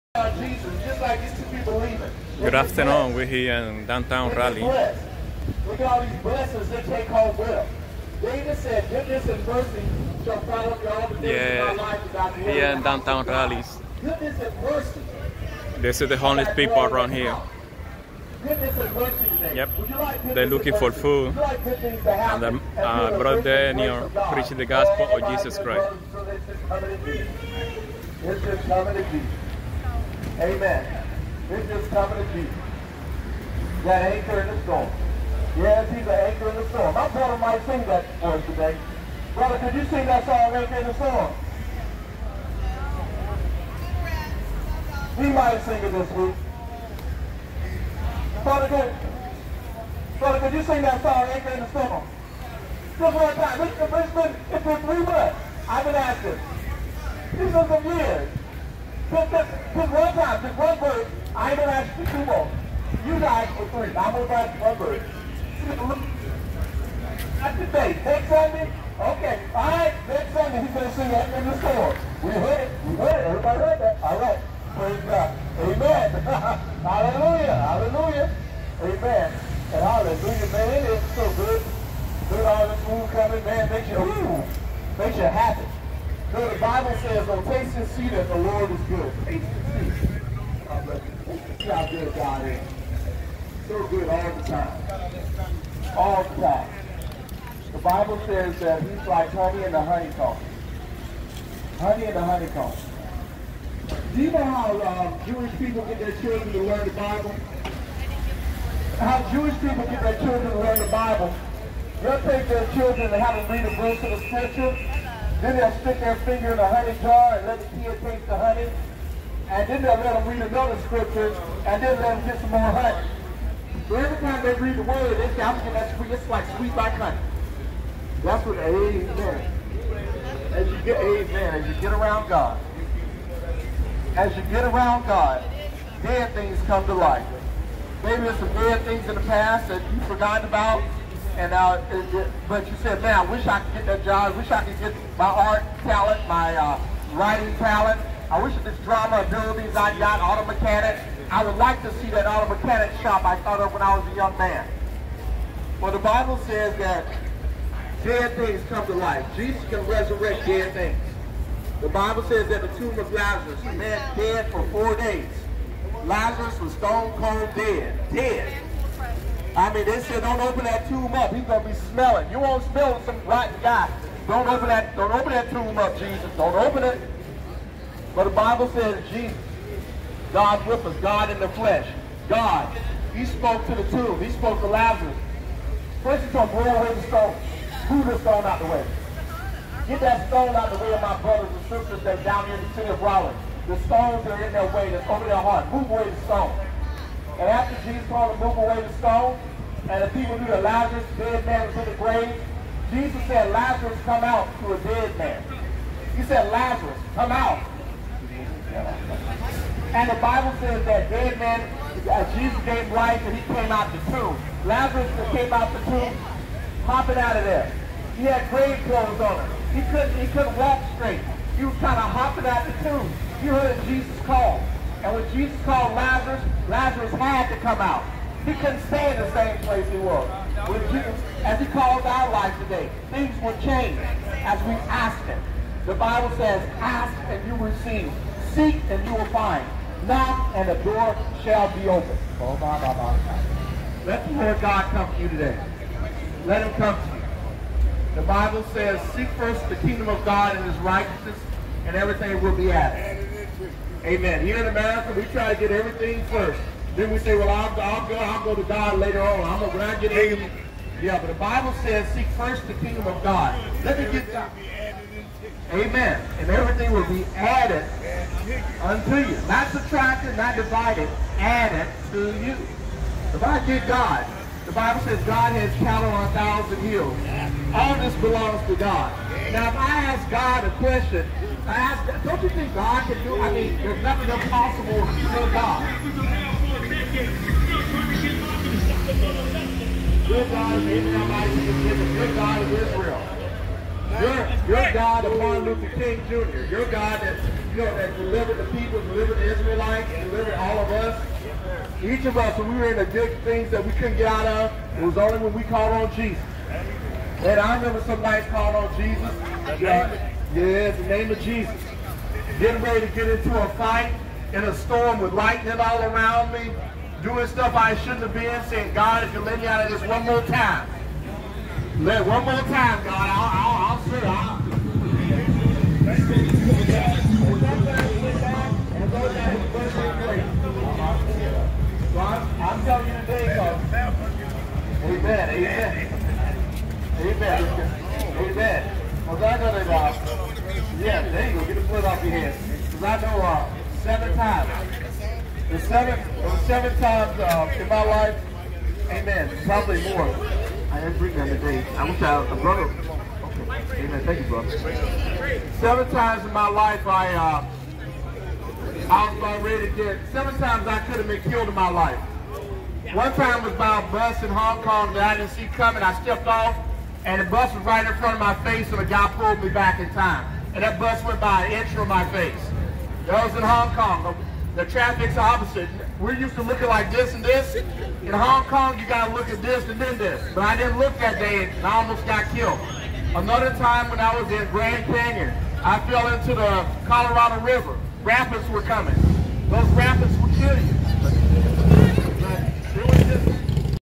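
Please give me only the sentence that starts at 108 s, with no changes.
How Jewish people get their children to learn the Bible?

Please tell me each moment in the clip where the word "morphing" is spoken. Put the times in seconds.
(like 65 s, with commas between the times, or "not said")
not said.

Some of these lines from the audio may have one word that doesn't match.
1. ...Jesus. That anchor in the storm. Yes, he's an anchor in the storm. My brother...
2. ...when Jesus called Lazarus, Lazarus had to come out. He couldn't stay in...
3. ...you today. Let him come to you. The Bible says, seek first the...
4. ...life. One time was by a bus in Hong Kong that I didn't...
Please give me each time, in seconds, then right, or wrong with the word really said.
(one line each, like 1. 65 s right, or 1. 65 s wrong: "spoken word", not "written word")
1. 32 s right
2. 225 s right
3. 245 s right
4. 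361 s right.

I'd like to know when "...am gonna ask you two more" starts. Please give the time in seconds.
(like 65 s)
61 s.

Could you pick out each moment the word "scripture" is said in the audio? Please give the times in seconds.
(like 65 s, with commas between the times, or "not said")
114 s, 120 s.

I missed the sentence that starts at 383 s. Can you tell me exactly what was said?
Another time when I was in Grand Canyon, I fell into the Colorado River.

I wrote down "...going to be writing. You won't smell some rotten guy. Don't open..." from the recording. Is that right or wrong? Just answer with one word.
wrong.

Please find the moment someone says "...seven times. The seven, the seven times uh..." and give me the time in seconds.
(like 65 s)
344 s.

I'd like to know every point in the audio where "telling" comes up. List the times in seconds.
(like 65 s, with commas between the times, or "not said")
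332 s.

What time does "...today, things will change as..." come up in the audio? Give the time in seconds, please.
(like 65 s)
232 s.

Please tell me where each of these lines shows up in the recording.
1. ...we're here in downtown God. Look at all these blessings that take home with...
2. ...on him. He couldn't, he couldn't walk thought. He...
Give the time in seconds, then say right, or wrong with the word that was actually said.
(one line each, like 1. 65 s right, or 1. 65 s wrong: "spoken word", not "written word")
1. 3 s wrong: "Raleigh", not "God"
2. 219 s wrong: "straight", not "thought".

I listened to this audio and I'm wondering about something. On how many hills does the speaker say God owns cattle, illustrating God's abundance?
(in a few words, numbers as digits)
1000.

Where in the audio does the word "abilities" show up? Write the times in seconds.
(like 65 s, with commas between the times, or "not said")
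149 s.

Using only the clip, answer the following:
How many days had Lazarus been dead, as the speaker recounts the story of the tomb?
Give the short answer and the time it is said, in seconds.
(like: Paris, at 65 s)
4, at 164 s.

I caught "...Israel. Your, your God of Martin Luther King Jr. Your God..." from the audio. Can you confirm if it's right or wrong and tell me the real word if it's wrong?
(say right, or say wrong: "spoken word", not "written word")
right.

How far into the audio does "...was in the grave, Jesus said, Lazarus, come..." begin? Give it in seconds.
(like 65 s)
201 s.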